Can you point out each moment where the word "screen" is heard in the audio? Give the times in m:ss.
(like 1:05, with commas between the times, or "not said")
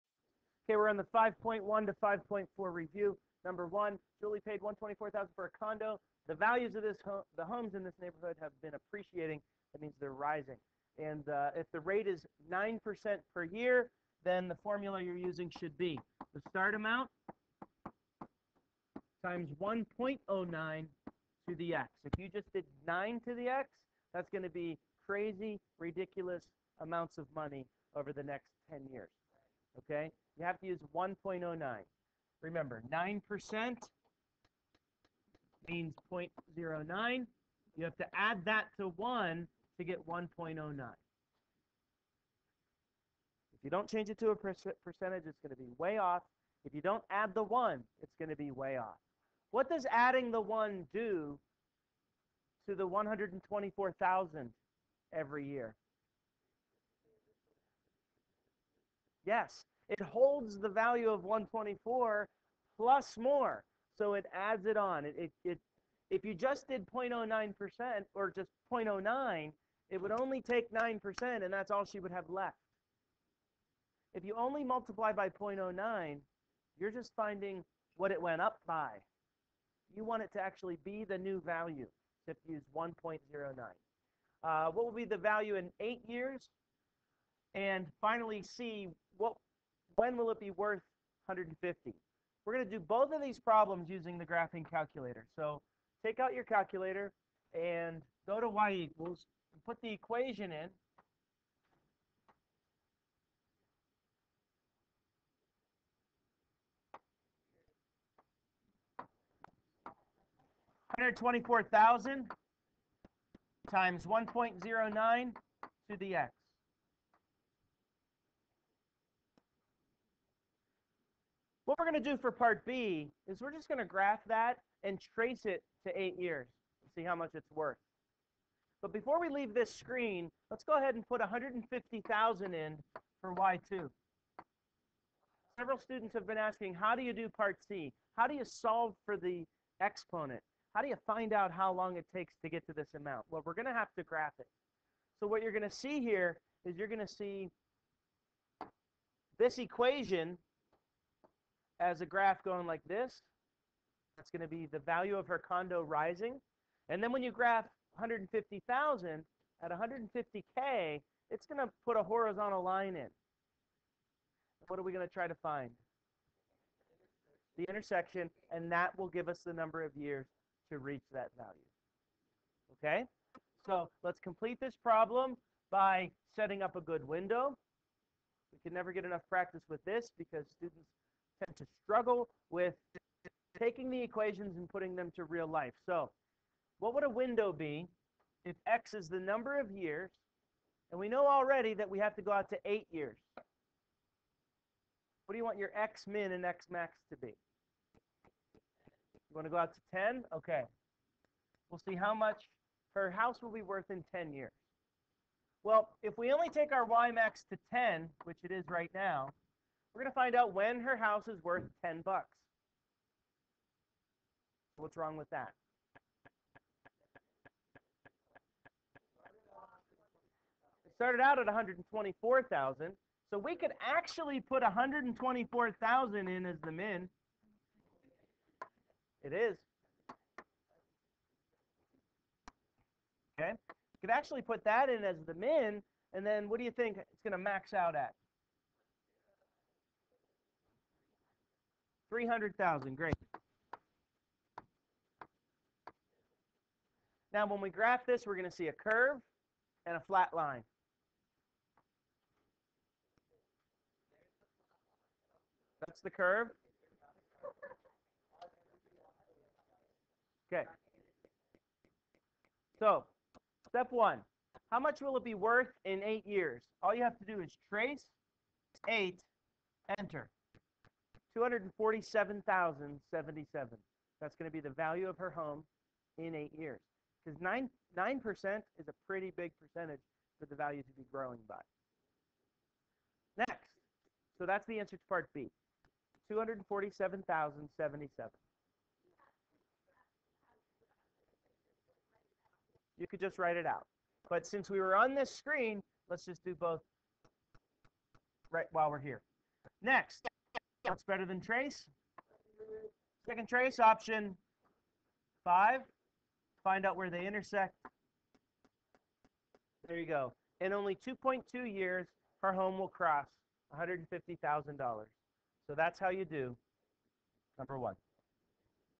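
2:09, 4:55.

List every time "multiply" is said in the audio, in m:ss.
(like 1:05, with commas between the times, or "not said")
1:14.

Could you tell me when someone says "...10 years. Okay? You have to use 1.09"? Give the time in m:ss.
0:28.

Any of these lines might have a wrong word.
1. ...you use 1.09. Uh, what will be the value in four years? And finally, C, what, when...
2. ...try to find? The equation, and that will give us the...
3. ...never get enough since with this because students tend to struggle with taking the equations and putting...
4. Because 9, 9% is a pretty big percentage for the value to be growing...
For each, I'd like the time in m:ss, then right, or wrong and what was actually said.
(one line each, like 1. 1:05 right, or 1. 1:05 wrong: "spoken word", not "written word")
1. 1:22 wrong: "eight", not "four"
2. 2:45 wrong: "intersection", not "equation"
3. 2:58 wrong: "practice", not "since"
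4. 4:37 right.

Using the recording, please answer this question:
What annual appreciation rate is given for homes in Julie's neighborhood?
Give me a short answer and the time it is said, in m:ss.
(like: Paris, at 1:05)
9%, at 0:12.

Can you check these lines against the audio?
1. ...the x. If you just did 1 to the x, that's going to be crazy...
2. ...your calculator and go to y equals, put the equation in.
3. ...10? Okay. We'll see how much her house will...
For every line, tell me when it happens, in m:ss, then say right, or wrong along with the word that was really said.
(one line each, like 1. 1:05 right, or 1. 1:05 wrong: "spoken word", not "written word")
1. 0:21 wrong: "9", not "1"
2. 1:36 right
3. 3:19 right.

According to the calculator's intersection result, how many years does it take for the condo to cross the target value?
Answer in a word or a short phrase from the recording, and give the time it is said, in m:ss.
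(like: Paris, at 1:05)
2.2 years, at 5:10.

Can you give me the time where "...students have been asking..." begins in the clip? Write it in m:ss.
2:15.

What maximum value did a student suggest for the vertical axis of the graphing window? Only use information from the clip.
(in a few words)
300,000.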